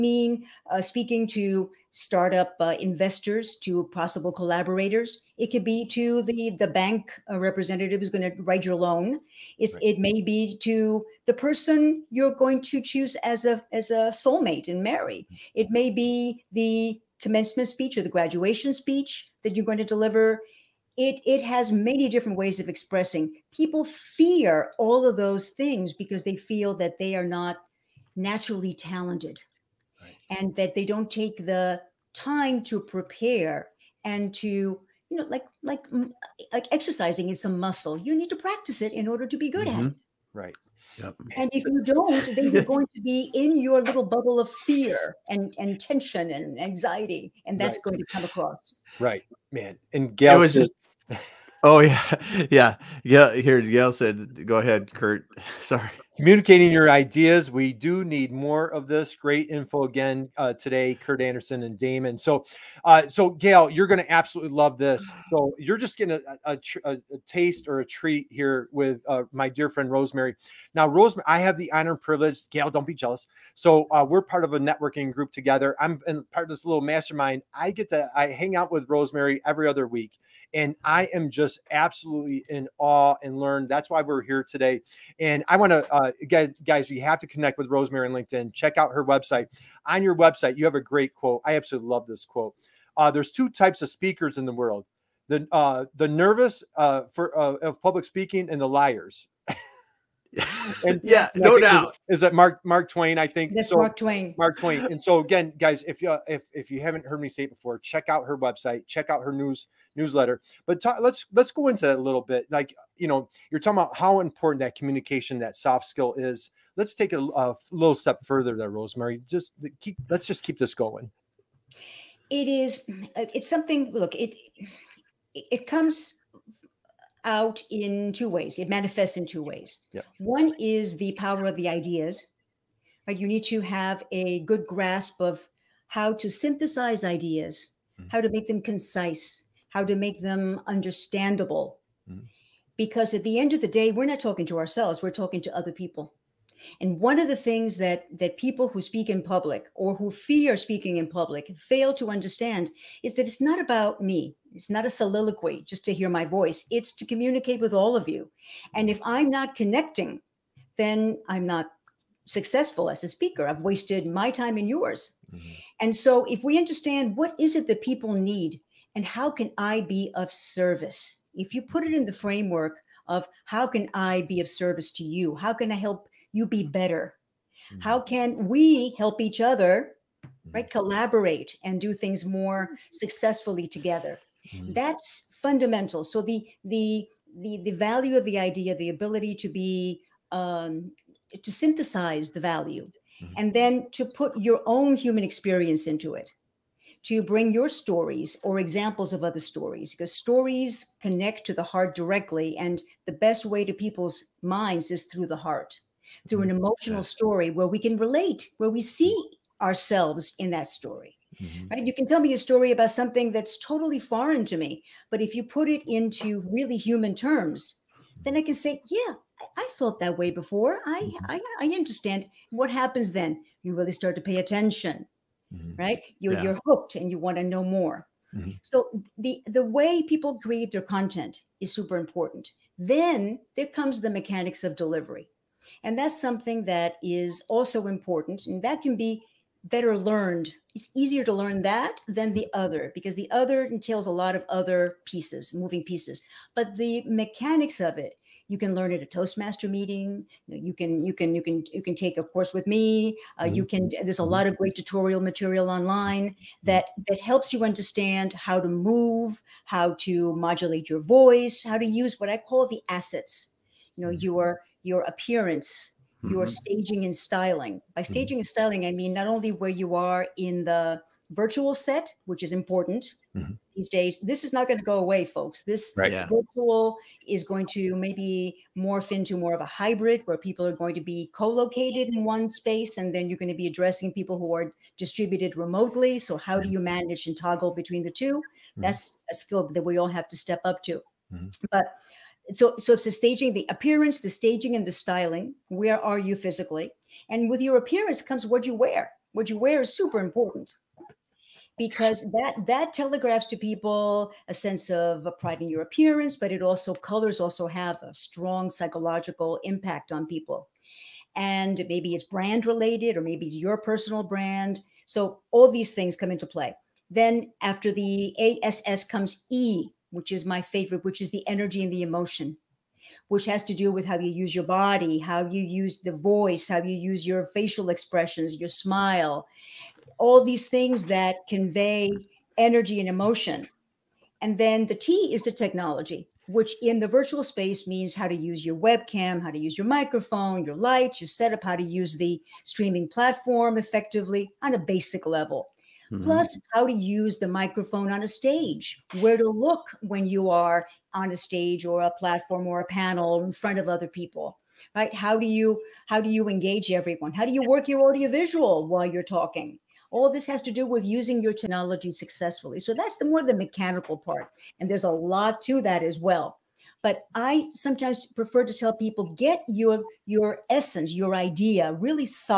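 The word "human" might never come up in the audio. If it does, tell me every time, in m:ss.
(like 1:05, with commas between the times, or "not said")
3:14, 3:36.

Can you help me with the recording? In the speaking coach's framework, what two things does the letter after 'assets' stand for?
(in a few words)
energy and emotion.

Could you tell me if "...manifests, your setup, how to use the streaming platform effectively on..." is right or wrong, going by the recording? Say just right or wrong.
wrong.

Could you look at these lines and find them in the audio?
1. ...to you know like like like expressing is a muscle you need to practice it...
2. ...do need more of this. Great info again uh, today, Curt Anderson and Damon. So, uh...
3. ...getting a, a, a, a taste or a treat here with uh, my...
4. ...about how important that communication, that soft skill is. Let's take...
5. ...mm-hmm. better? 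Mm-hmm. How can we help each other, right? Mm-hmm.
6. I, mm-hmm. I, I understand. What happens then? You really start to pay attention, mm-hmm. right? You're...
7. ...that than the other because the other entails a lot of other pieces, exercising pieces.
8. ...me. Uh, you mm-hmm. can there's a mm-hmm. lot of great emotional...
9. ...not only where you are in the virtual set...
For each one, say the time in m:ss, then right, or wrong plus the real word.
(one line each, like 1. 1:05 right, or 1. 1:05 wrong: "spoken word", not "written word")
1. 0:34 wrong: "exercising", not "expressing"
2. 0:57 right
3. 1:05 right
4. 1:53 right
5. 2:56 right
6. 3:40 right
7. 4:01 wrong: "moving", not "exercising"
8. 4:12 wrong: "tutorial", not "emotional"
9. 4:29 right.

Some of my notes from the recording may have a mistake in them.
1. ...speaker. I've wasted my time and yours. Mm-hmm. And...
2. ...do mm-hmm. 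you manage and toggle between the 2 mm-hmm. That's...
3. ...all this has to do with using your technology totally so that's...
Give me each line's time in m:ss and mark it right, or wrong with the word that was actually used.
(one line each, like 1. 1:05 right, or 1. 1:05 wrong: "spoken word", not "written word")
1. 2:43 right
2. 4:46 right
3. 6:00 wrong: "successfully", not "totally".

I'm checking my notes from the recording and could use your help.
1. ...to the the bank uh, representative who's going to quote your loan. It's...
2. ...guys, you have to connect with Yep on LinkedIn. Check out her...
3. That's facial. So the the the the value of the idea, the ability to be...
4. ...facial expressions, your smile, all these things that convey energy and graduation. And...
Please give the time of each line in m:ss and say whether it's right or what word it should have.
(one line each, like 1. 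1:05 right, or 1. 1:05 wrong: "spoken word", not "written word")
1. 0:05 wrong: "write", not "quote"
2. 1:26 wrong: "Rosemary", not "Yep"
3. 3:04 wrong: "fundamental", not "facial"
4. 5:27 wrong: "emotion", not "graduation".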